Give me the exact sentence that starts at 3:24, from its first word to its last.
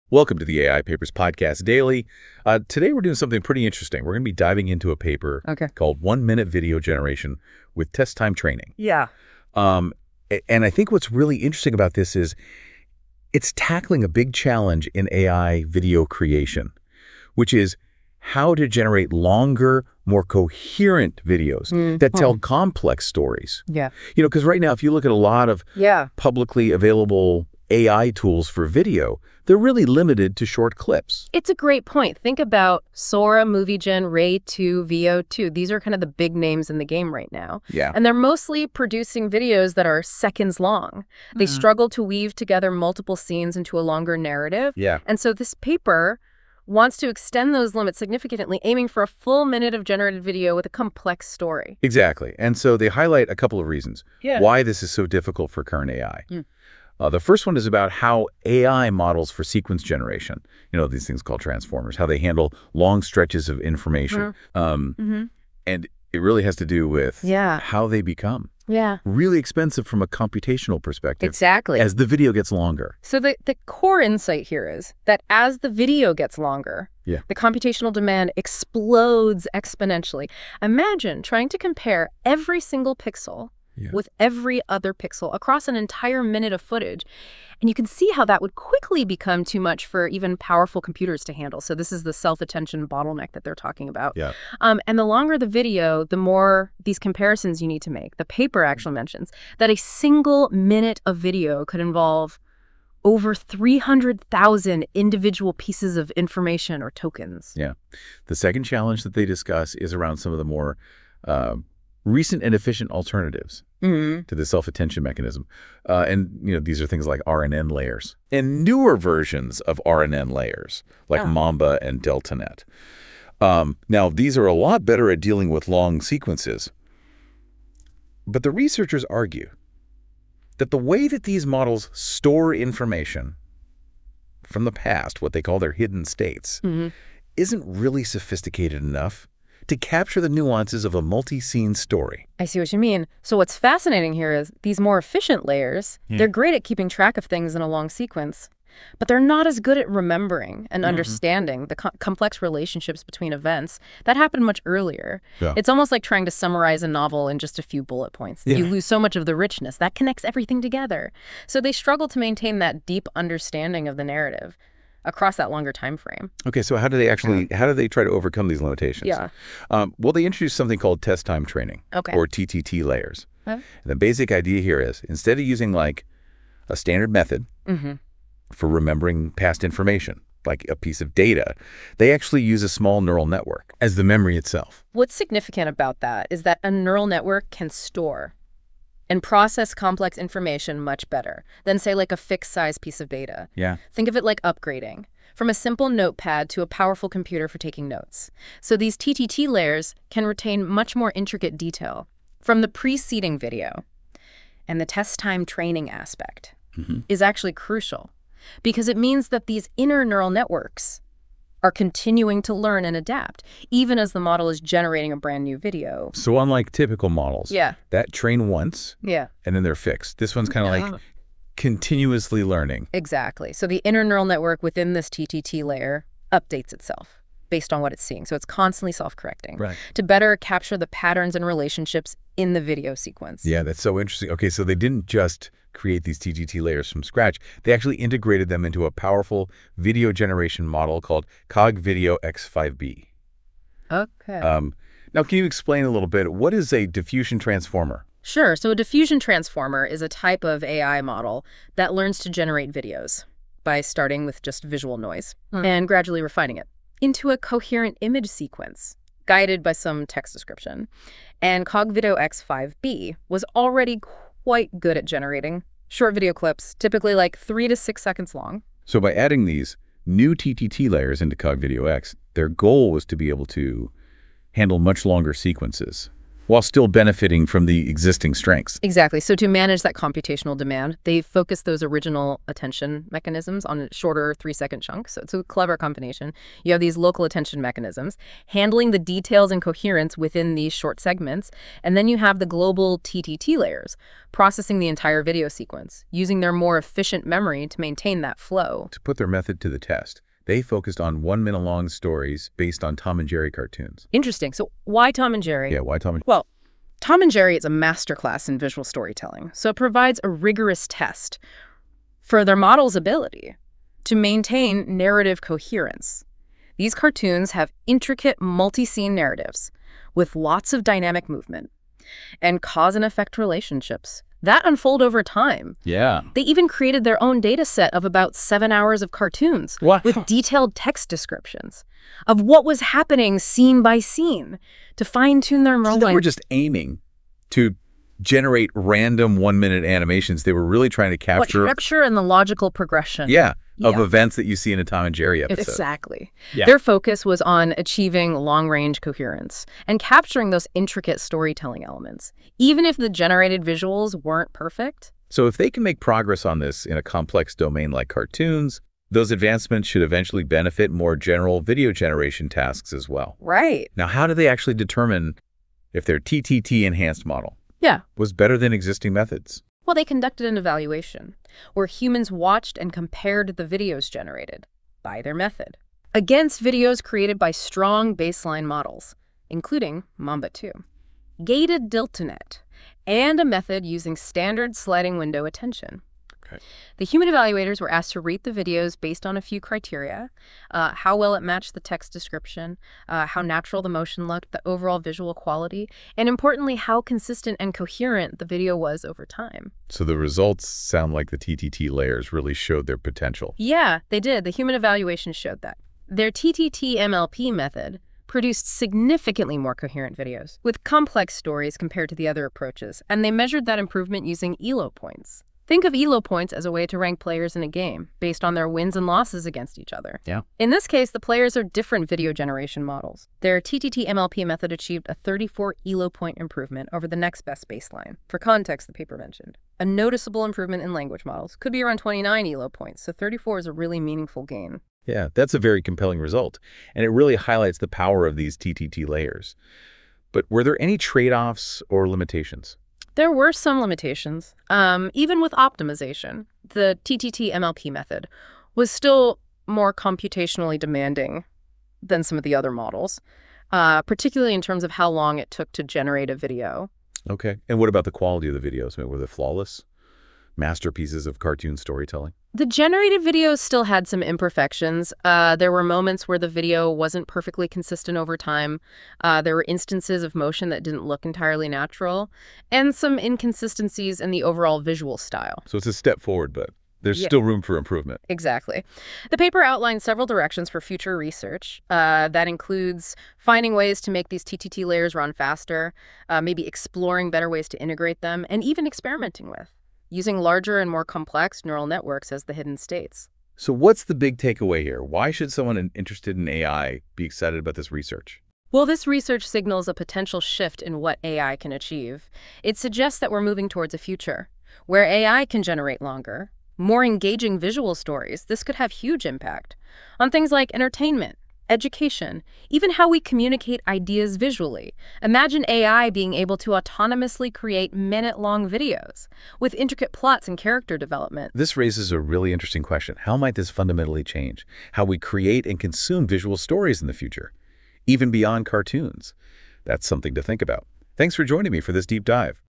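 And the test time training aspect mm -hmm.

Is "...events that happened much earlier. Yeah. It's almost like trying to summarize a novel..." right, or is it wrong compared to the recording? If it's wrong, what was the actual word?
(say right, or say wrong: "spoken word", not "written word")
right.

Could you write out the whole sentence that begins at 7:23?
There were some limitations, um, even with optimization.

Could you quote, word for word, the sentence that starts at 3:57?
They actually integrated them into a powerful video generation model called Cog Video X5B.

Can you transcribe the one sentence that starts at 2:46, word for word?
Okay, so how do they actually how do they try to overcome these limitations?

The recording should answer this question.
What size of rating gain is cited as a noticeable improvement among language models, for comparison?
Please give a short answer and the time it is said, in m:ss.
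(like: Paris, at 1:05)
29 Elo points, at 7:11.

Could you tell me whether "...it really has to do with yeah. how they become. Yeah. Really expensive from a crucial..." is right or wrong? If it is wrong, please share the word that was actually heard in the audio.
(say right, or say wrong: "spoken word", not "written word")
wrong: "computational", not "crucial".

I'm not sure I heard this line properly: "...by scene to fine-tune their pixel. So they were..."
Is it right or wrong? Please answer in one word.
wrong.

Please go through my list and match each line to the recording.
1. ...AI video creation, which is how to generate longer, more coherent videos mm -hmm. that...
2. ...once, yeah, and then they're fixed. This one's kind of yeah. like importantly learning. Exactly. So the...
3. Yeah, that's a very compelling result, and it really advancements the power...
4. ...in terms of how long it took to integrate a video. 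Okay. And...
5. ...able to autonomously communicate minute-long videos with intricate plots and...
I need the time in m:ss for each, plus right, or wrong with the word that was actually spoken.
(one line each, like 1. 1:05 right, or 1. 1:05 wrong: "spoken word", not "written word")
1. 0:15 right
2. 3:38 wrong: "continuously", not "importantly"
3. 7:15 wrong: "highlights", not "advancements"
4. 7:34 wrong: "generate", not "integrate"
5. 8:36 wrong: "create", not "communicate".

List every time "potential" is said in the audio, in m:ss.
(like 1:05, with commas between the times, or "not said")
6:42, 8:19.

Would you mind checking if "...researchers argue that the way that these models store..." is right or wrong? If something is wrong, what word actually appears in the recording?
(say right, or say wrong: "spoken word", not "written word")
right.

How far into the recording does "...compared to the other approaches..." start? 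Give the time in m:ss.
6:51.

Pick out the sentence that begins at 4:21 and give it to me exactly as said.
And CogVideo X5B was already quite good at generating short video clips, typically like three to six seconds long.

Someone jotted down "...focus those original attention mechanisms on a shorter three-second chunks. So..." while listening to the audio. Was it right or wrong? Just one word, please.
right.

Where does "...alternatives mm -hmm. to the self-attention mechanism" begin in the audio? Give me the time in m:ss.
1:52.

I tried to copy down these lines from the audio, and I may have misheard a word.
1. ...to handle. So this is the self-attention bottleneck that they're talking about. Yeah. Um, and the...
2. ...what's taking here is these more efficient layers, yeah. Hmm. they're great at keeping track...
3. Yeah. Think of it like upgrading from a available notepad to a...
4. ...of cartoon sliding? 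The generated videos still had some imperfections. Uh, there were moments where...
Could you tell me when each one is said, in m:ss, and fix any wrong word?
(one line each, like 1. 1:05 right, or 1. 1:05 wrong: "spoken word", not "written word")
1. 1:31 right
2. 2:23 wrong: "fascinating", not "taking"
3. 3:13 wrong: "simple", not "available"
4. 7:41 wrong: "storytelling", not "sliding".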